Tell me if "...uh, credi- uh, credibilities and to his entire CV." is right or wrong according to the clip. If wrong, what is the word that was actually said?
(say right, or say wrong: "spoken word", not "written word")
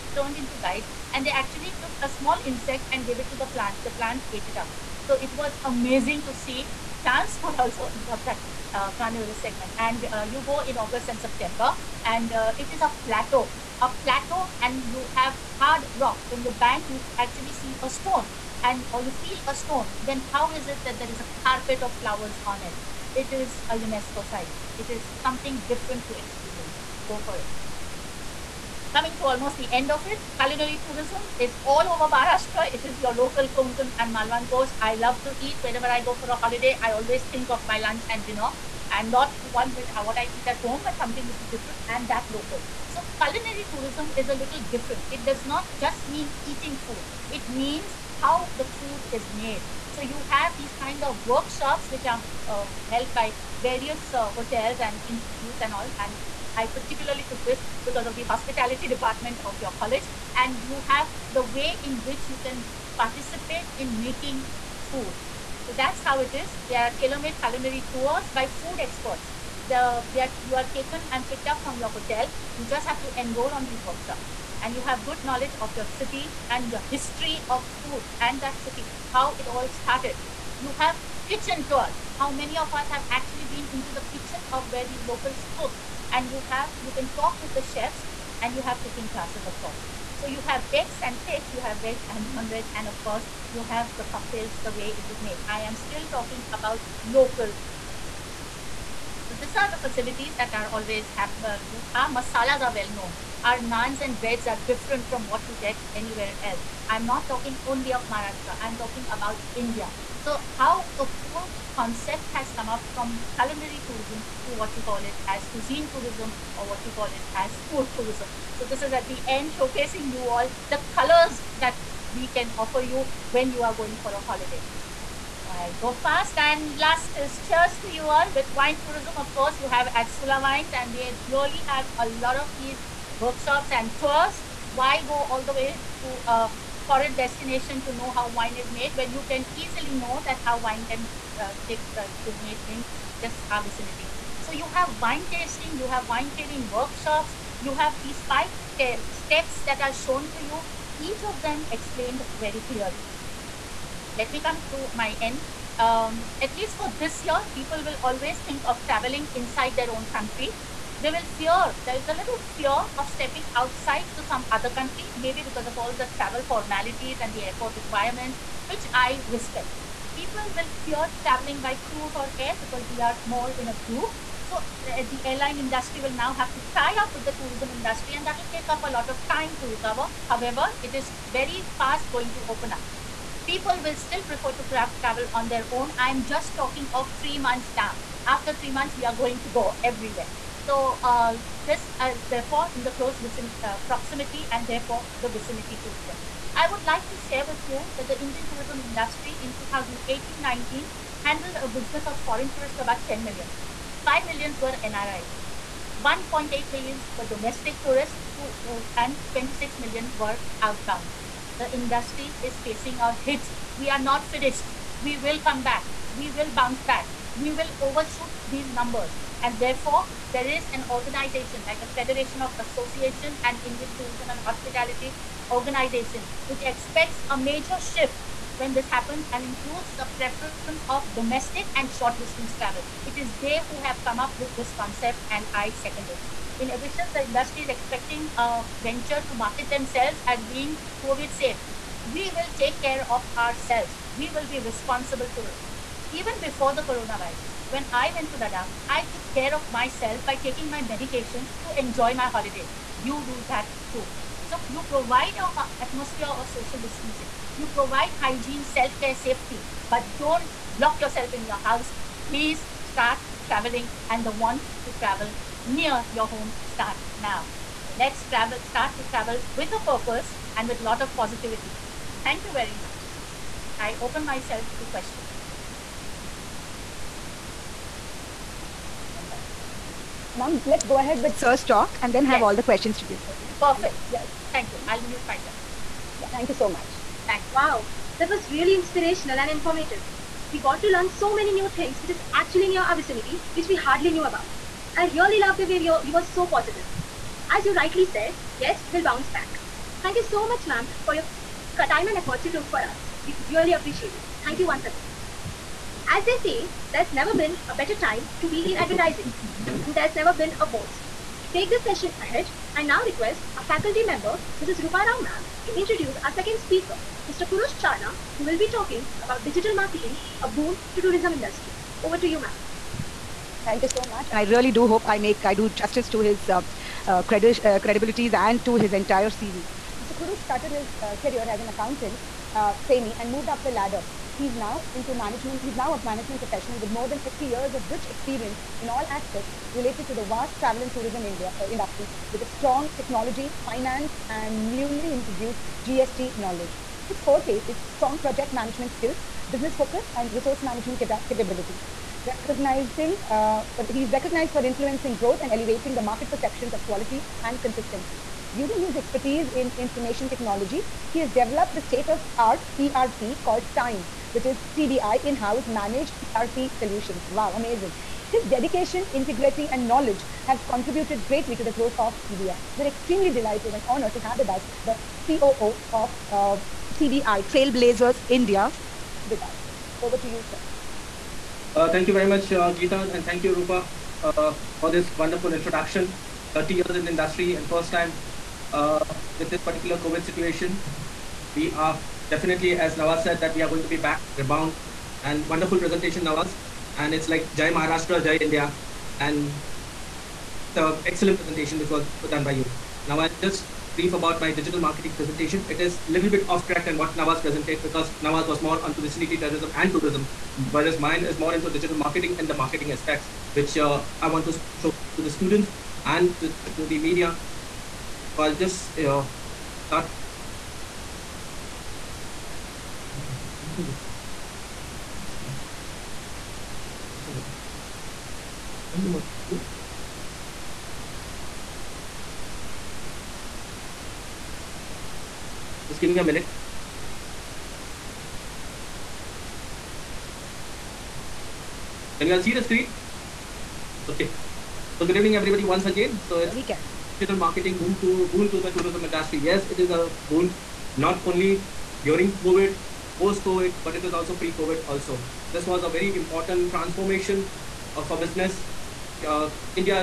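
right.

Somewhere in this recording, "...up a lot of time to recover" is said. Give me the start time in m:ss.
2:58.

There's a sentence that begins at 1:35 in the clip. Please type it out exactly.
I am still talking about local so these are the facilities that are always have.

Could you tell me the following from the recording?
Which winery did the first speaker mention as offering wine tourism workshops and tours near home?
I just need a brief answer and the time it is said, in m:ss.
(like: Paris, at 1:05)
Sula Wines, at 2:10.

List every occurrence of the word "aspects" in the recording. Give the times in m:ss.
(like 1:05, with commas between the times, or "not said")
5:39, 6:52.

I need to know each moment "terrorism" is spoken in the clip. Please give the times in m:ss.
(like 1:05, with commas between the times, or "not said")
6:49.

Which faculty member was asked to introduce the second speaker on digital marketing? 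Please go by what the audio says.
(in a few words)
Roopa Rao.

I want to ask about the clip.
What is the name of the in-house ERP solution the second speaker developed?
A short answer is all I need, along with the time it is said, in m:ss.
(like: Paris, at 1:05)
TIMES, at 6:03.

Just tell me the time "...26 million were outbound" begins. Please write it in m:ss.
3:29.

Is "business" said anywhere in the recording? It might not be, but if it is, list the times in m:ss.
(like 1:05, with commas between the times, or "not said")
3:21, 5:49, 7:38.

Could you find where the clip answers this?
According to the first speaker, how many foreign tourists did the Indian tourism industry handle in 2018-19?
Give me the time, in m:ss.
3:22.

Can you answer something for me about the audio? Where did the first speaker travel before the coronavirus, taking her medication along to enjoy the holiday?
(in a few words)
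Ladakh.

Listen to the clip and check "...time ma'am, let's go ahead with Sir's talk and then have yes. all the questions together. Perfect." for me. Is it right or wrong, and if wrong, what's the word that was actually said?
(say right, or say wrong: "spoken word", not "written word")
right.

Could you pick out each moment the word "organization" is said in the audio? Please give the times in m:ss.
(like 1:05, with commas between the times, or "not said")
3:40, 3:45.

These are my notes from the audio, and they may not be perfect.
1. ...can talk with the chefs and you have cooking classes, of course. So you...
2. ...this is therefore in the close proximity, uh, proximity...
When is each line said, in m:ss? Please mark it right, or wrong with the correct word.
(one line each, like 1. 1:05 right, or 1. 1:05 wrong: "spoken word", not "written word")
1. 1:26 right
2. 3:11 wrong: "vicinity", not "proximity".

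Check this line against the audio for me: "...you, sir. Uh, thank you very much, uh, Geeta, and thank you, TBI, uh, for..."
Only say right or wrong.
wrong.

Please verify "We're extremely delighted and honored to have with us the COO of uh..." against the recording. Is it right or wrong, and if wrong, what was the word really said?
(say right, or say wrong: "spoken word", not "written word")
right.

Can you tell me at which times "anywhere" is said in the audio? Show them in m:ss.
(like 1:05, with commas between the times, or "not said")
1:45.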